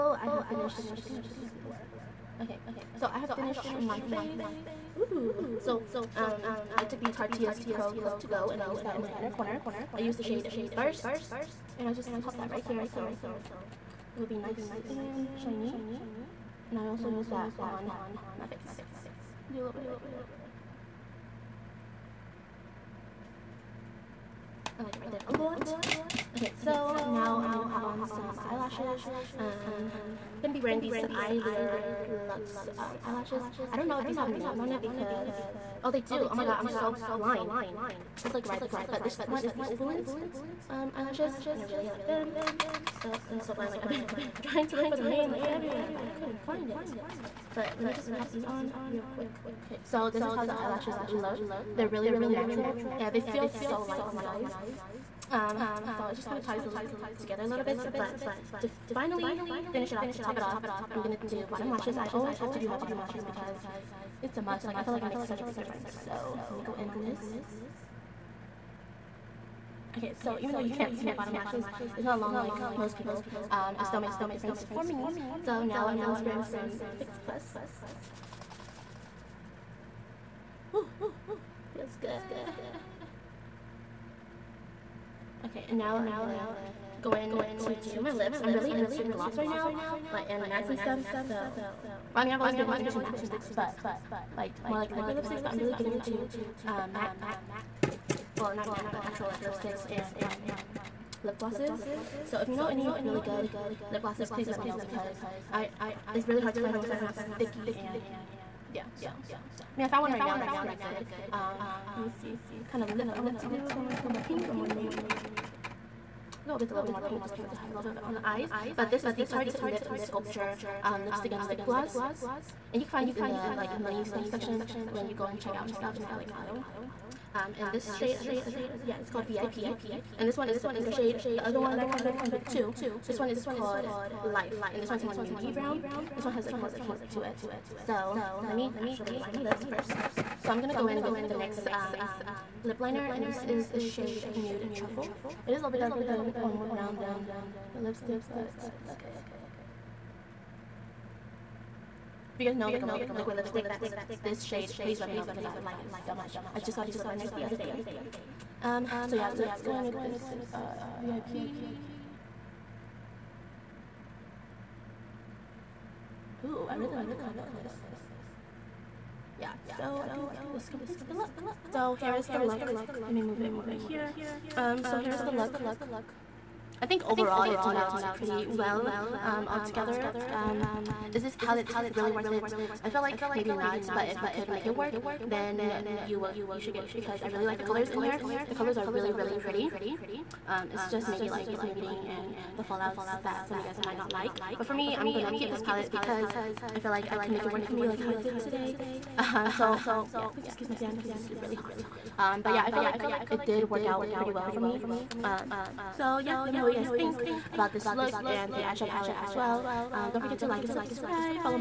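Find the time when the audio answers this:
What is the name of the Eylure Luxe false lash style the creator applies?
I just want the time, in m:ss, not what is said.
0:39.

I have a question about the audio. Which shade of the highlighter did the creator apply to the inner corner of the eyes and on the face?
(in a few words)
Burst.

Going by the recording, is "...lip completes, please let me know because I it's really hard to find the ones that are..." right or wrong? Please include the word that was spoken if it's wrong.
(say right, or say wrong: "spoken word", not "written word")
wrong: "glosses", not "completes".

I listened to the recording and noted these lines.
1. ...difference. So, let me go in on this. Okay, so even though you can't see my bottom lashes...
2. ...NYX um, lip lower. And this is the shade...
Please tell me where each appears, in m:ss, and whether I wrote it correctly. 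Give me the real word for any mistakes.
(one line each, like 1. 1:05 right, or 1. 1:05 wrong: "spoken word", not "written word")
1. 1:05 right
2. 2:21 wrong: "liner", not "lower".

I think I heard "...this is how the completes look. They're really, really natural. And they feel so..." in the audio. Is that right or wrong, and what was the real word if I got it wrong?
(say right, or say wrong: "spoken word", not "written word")
wrong: "eyelashes", not "completes".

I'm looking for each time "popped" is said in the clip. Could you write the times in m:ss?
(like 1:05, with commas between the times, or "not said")
0:12.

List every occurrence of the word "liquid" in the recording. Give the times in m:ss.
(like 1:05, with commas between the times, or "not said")
1:34, 2:33.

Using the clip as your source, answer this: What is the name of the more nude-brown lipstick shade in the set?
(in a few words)
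Life.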